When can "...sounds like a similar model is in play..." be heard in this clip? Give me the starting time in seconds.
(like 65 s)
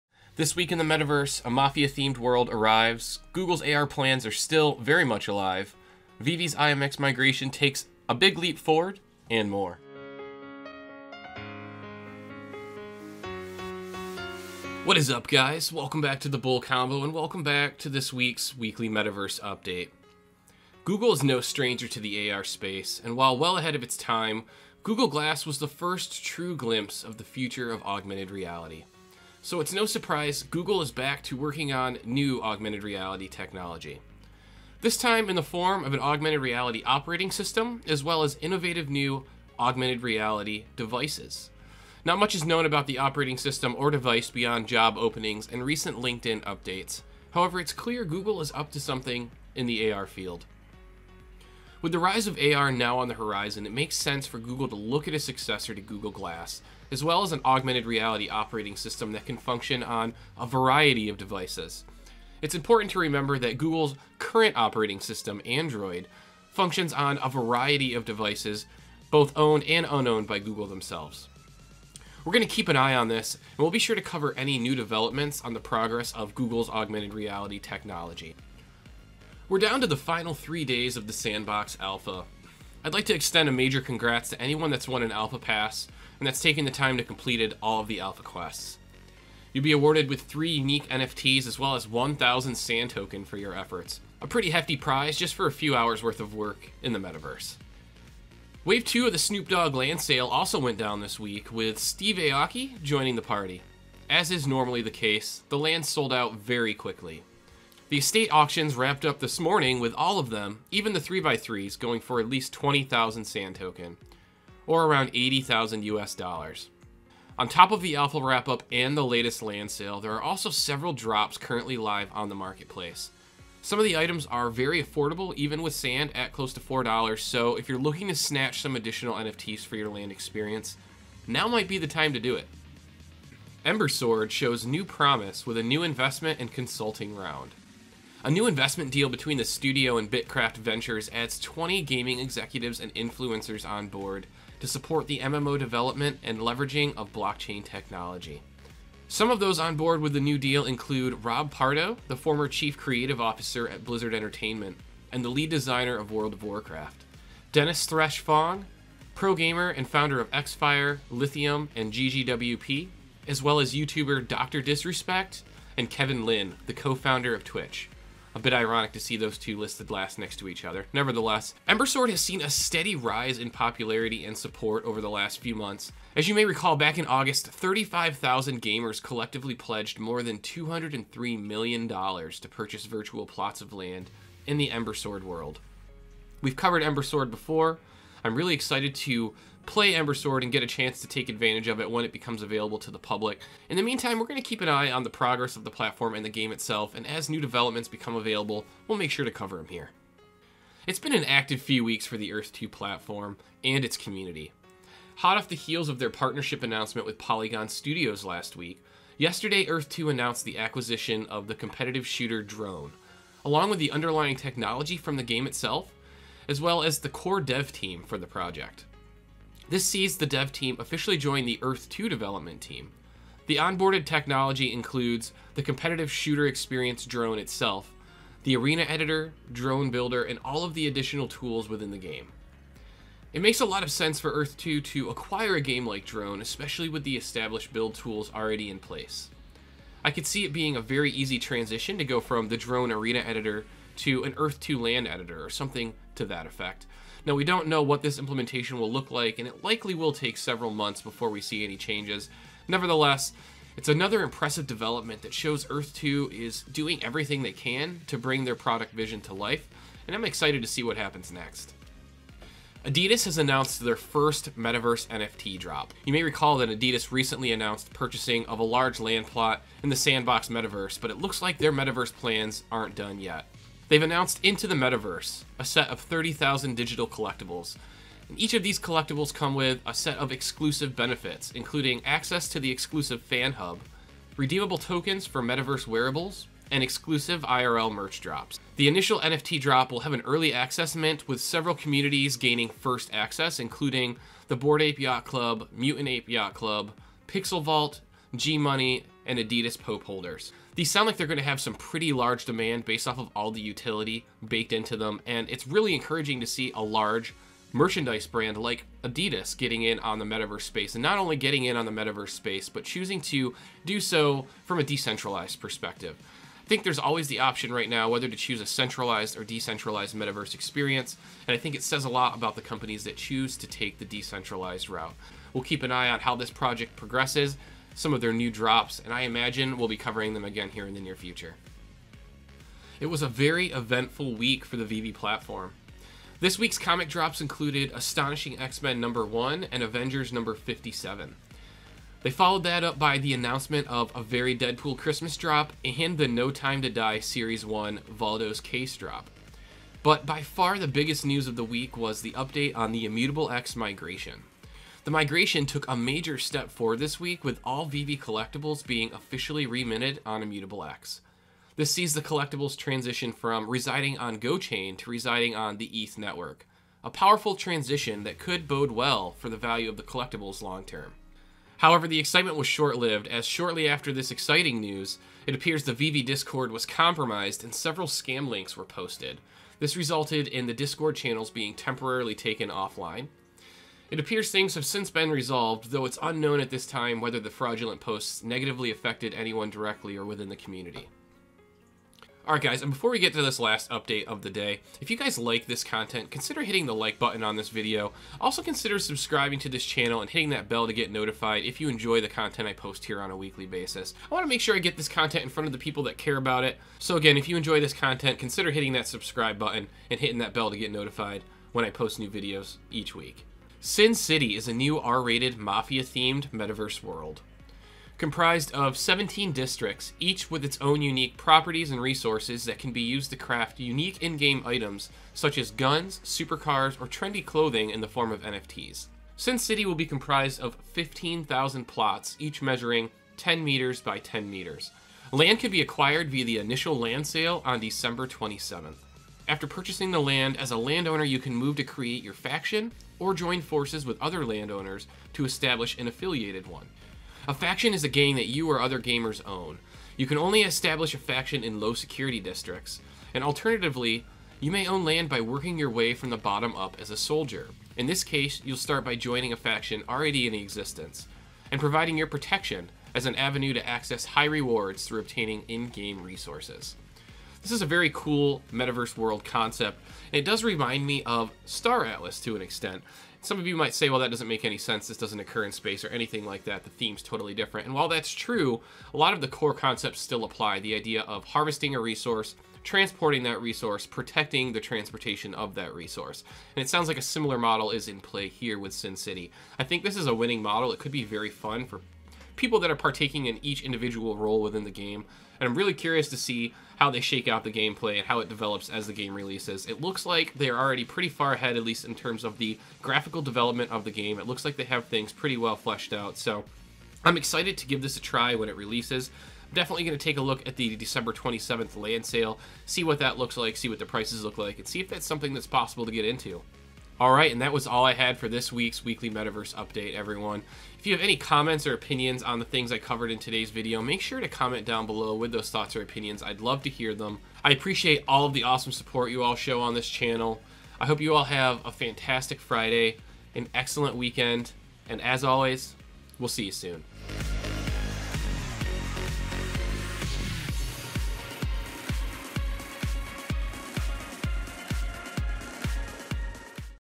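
486 s.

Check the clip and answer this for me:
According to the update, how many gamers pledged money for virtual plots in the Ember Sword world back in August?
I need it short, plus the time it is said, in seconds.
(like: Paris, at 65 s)
35,000, at 177 s.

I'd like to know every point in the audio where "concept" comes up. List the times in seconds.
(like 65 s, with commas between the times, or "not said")
469 s, 479 s.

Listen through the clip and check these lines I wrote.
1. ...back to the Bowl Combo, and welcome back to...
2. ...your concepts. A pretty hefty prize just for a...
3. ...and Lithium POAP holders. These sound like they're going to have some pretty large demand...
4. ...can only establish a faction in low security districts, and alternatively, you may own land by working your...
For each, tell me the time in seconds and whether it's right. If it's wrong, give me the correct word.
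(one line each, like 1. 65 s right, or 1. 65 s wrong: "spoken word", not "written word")
1. 16 s right
2. 93 s wrong: "efforts", not "concepts"
3. 299 s wrong: "Adidas", not "Lithium"
4. 450 s right.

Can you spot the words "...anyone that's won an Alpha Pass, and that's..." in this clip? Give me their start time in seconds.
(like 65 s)
84 s.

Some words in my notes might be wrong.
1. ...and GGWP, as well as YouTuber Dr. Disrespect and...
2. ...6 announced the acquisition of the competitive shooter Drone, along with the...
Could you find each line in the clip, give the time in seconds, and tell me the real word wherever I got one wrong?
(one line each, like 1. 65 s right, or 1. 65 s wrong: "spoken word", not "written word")
1. 161 s right
2. 209 s wrong: "2", not "6".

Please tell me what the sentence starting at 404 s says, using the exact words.
I want to make sure I get this content in front of the people that care about it.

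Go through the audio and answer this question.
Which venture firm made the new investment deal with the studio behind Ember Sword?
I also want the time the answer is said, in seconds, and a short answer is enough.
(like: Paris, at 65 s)
BITKRAFT Ventures, at 140 s.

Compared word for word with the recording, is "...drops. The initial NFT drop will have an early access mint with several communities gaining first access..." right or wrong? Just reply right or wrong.
right.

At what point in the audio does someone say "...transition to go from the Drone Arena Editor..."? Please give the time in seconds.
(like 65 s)
241 s.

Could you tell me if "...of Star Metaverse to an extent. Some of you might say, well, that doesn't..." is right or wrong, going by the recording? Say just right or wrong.
wrong.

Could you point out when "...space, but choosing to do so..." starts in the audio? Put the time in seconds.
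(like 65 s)
312 s.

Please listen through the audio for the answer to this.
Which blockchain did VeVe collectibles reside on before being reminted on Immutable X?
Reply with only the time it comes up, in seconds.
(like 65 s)
364 s.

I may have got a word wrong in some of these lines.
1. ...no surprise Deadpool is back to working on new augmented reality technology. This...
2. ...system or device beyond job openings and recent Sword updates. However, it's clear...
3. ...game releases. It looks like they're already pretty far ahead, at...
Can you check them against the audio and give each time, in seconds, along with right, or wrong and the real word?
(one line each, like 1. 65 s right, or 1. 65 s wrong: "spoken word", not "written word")
1. 29 s wrong: "Google", not "Deadpool"
2. 43 s wrong: "LinkedIn", not "Sword"
3. 499 s right.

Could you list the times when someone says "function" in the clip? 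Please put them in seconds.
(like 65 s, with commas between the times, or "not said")
59 s, 66 s.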